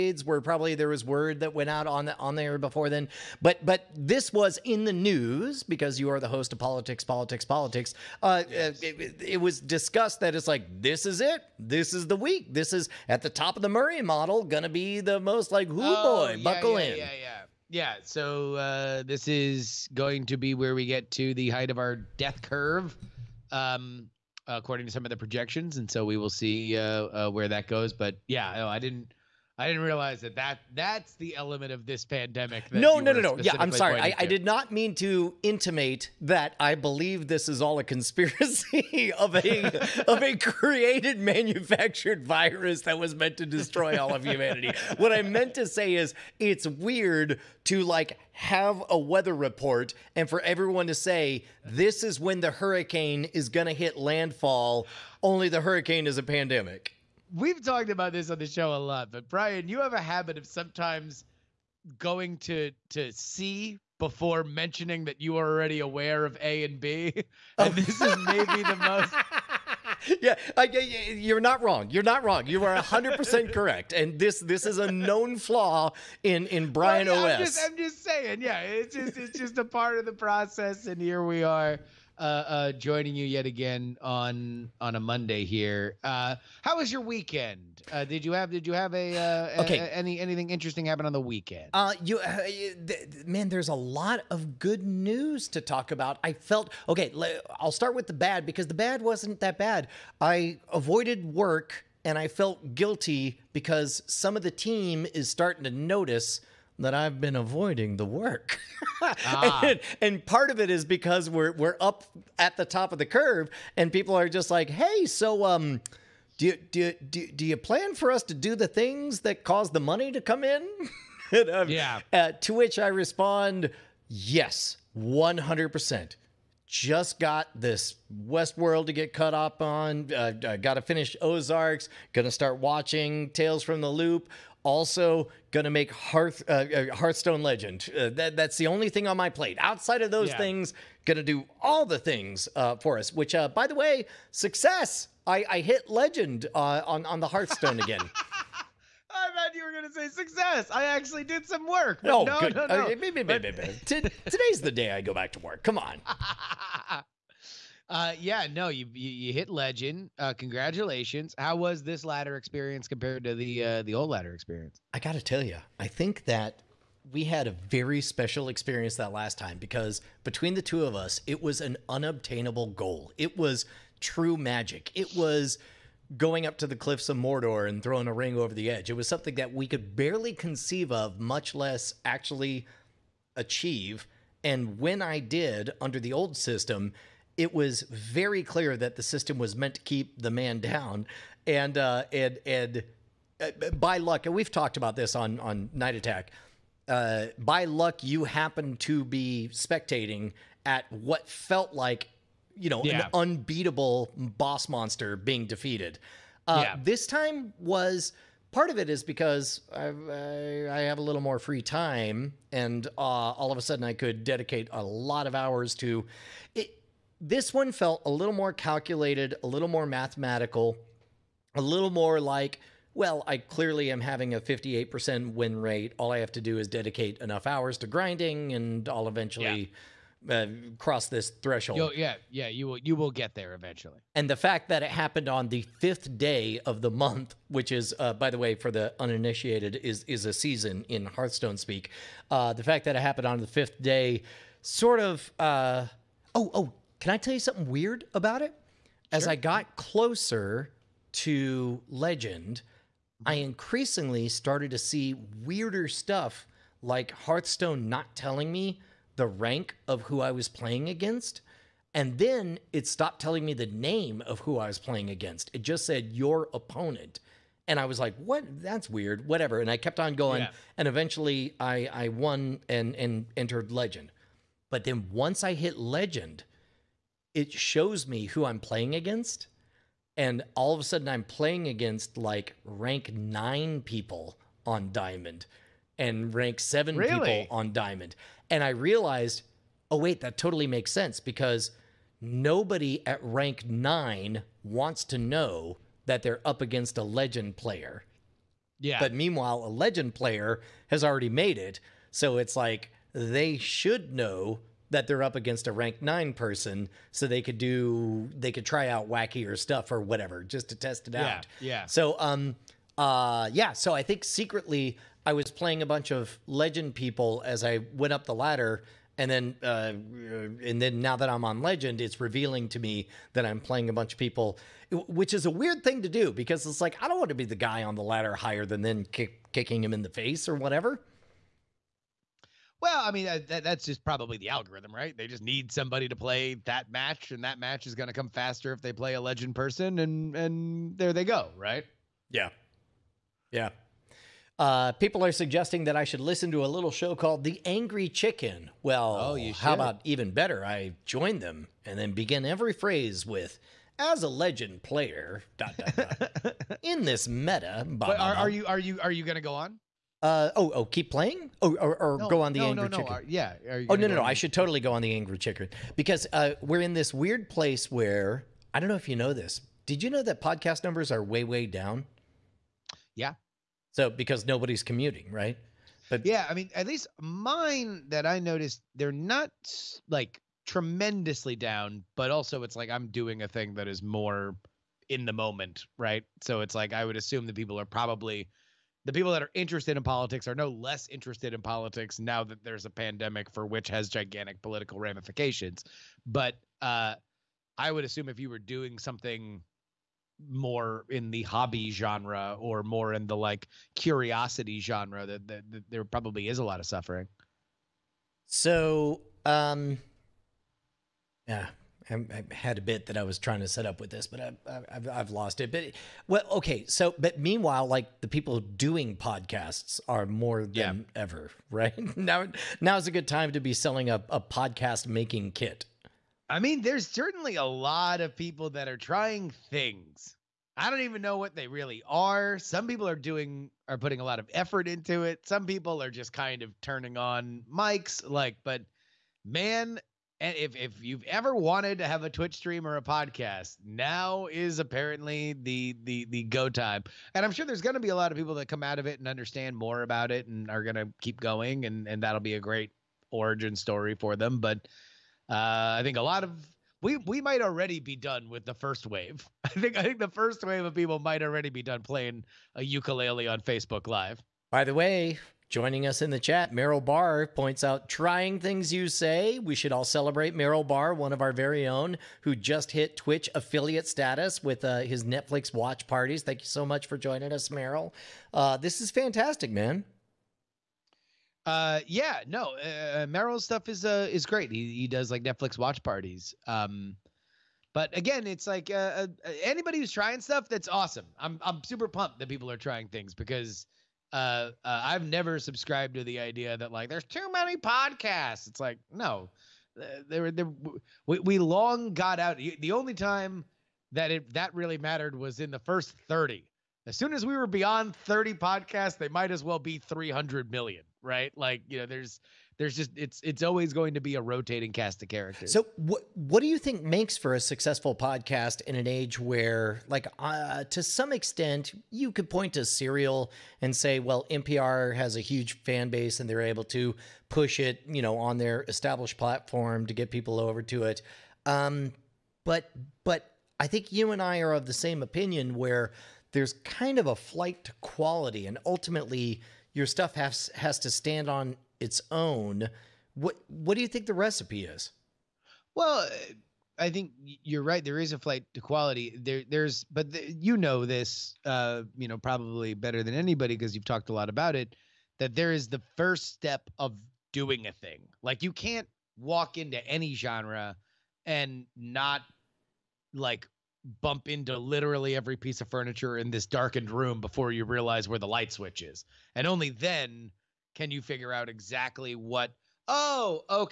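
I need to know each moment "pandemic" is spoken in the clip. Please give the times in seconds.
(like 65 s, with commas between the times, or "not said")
32 s, 56 s, 392 s.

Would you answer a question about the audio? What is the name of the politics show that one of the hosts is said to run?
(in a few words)
Politics, Politics, Politics.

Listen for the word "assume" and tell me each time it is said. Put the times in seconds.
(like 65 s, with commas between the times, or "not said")
387 s, 398 s.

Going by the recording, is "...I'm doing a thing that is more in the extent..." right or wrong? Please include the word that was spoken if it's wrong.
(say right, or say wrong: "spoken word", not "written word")
wrong: "moment", not "extent".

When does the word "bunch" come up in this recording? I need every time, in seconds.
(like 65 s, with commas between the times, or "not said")
315 s, 323 s.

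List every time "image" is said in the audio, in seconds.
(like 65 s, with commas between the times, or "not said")
not said.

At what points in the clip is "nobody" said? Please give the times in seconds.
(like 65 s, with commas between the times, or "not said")
292 s, 374 s.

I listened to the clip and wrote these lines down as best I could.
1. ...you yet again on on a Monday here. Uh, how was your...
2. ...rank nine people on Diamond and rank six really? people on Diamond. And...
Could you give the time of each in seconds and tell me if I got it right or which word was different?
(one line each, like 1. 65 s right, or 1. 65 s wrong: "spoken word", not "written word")
1. 83 s right
2. 282 s wrong: "seven", not "six".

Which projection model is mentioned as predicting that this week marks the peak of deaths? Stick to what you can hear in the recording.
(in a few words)
Murray model.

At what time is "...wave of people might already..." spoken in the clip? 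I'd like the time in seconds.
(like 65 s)
460 s.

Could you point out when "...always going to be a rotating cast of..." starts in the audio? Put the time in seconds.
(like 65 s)
513 s.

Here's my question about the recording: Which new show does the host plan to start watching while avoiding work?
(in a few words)
Tales from the Loop.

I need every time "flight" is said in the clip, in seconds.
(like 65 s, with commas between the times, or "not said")
537 s, 548 s.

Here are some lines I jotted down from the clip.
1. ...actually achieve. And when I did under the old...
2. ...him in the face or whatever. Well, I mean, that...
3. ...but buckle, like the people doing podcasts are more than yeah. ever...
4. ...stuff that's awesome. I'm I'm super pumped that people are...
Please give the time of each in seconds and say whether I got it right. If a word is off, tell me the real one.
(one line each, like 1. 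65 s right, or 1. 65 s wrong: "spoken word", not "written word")
1. 182 s right
2. 329 s right
3. 417 s wrong: "meanwhile", not "buckle"
4. 490 s right.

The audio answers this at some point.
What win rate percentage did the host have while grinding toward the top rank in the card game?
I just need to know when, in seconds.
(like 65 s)
224 s.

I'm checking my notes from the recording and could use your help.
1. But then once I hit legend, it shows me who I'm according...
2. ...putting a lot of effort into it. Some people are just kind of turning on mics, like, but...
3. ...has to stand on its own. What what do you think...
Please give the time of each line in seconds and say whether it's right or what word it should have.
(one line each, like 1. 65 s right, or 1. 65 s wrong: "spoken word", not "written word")
1. 274 s wrong: "playing", not "according"
2. 433 s right
3. 540 s right.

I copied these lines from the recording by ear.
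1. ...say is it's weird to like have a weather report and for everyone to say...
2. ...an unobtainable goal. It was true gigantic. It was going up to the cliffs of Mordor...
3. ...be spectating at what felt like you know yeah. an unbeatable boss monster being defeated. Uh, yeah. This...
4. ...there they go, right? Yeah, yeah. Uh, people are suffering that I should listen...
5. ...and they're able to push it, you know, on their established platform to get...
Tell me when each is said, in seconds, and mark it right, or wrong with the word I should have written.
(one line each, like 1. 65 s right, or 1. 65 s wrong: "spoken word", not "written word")
1. 45 s right
2. 171 s wrong: "magic", not "gigantic"
3. 199 s right
4. 340 s wrong: "suggesting", not "suffering"
5. 526 s right.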